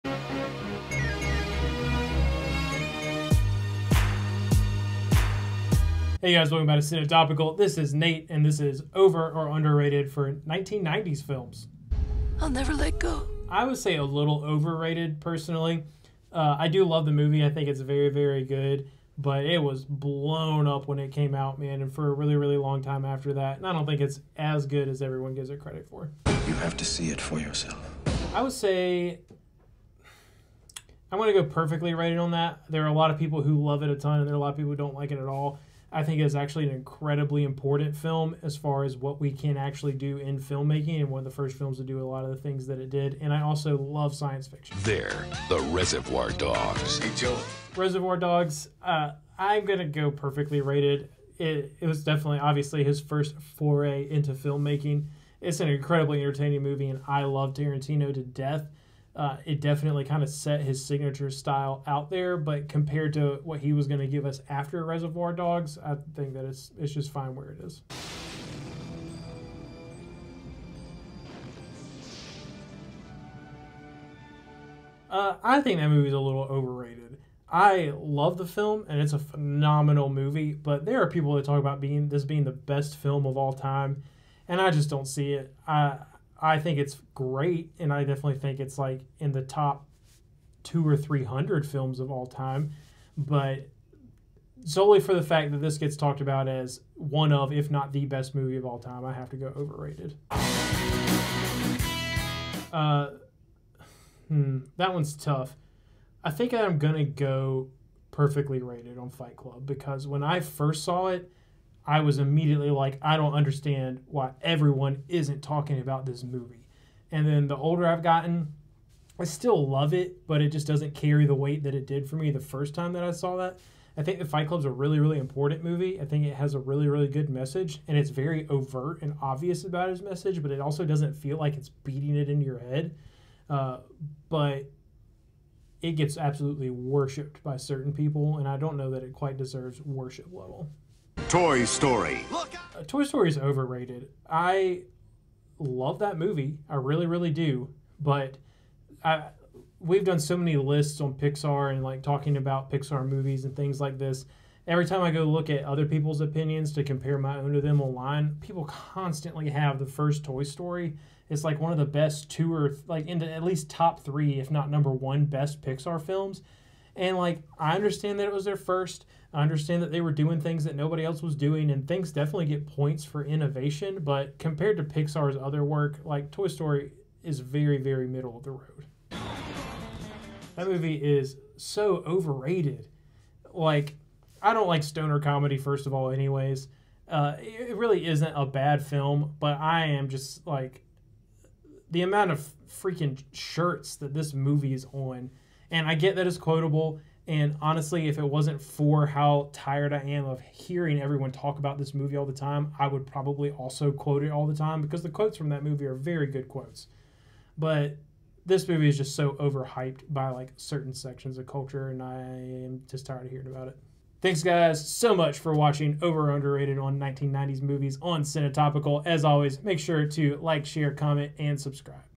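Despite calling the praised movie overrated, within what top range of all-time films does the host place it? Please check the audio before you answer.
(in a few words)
top two or three hundred.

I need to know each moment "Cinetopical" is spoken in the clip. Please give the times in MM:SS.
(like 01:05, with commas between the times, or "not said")
00:06, 03:38.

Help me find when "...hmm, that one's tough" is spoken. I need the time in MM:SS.
01:44.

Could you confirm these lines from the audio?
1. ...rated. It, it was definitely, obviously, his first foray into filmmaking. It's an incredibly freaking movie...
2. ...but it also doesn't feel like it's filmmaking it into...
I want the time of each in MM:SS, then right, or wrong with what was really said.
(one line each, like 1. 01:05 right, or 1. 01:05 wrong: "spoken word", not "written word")
1. 00:50 wrong: "entertaining", not "freaking"
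2. 02:10 wrong: "beating", not "filmmaking".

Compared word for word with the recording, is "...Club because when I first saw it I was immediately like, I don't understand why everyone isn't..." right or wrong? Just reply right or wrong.
right.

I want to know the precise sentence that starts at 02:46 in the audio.
And like, I understand that it was their first.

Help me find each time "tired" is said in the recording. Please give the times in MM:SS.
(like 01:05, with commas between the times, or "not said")
03:19, 03:33.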